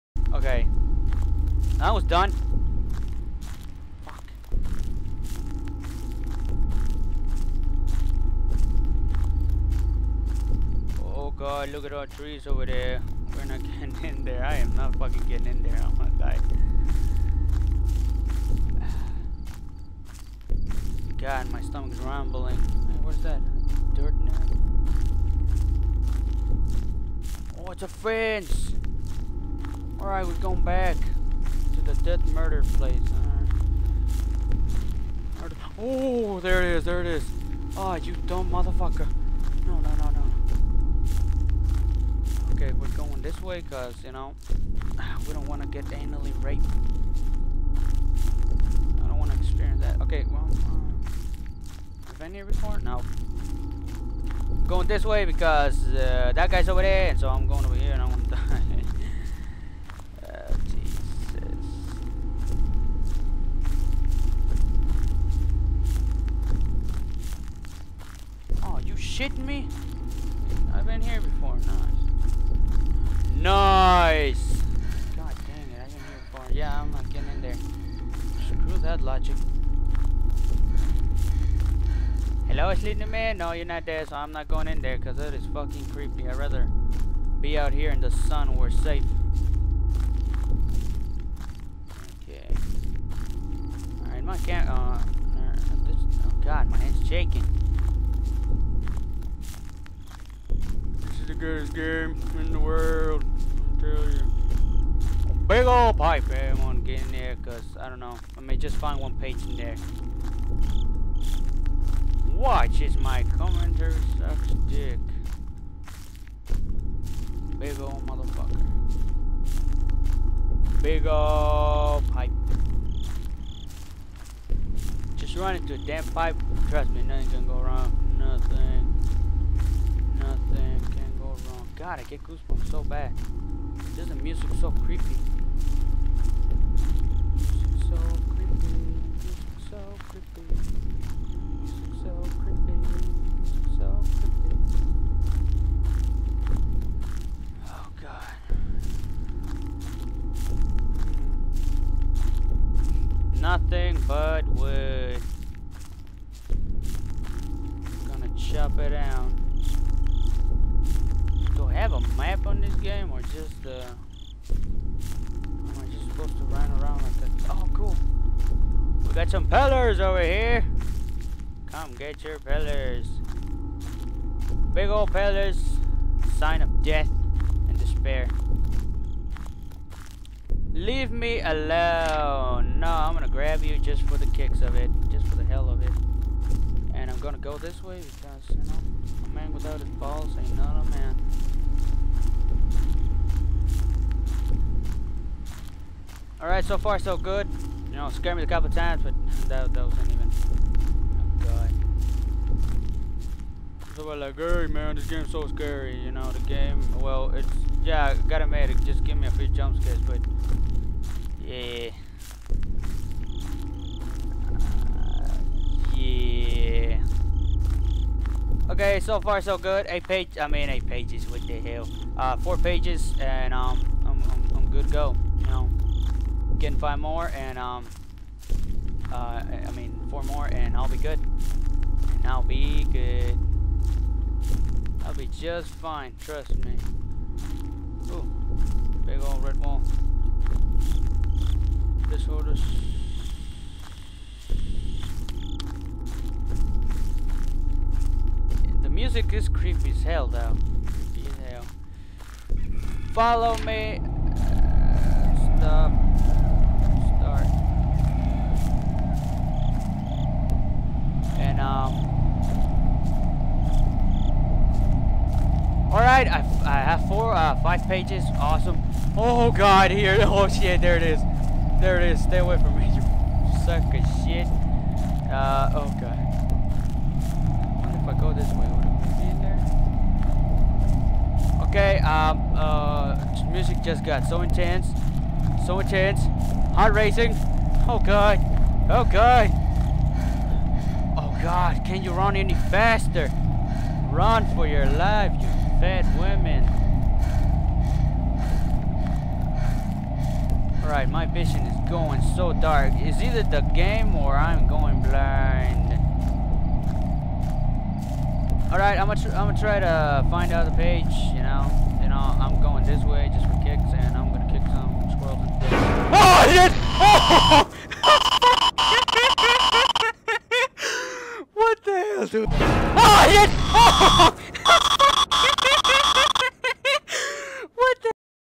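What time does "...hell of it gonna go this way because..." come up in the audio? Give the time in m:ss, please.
3:05.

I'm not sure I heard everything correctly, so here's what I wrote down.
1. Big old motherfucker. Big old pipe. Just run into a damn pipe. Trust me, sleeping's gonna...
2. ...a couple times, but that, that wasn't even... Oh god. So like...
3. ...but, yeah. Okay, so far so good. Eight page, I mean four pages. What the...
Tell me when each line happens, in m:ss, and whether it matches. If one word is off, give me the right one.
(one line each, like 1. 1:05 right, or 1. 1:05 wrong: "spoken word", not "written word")
1. 1:57 wrong: "nothing", not "sleeping"
2. 3:18 right
3. 3:29 wrong: "eight", not "four".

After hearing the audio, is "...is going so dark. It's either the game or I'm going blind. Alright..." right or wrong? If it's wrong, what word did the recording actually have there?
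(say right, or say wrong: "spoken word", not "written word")
right.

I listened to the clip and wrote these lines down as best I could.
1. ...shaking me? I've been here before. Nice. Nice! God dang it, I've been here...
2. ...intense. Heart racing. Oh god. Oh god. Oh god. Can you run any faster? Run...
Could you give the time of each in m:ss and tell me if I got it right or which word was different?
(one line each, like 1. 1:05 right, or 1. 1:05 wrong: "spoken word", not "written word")
1. 1:09 wrong: "shitting", not "shaking"
2. 4:45 right.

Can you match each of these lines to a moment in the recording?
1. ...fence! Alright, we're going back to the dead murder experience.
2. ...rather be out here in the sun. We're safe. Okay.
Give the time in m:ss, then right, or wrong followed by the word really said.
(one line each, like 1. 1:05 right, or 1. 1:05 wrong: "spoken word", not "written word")
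1. 0:27 wrong: "place", not "experience"
2. 1:26 right.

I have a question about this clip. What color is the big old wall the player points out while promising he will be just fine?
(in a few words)
red.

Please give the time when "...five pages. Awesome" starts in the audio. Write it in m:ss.
4:27.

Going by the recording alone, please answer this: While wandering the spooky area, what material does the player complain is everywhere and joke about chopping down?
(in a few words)
wood.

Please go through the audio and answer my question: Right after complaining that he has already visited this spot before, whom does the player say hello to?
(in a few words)
sleeping man.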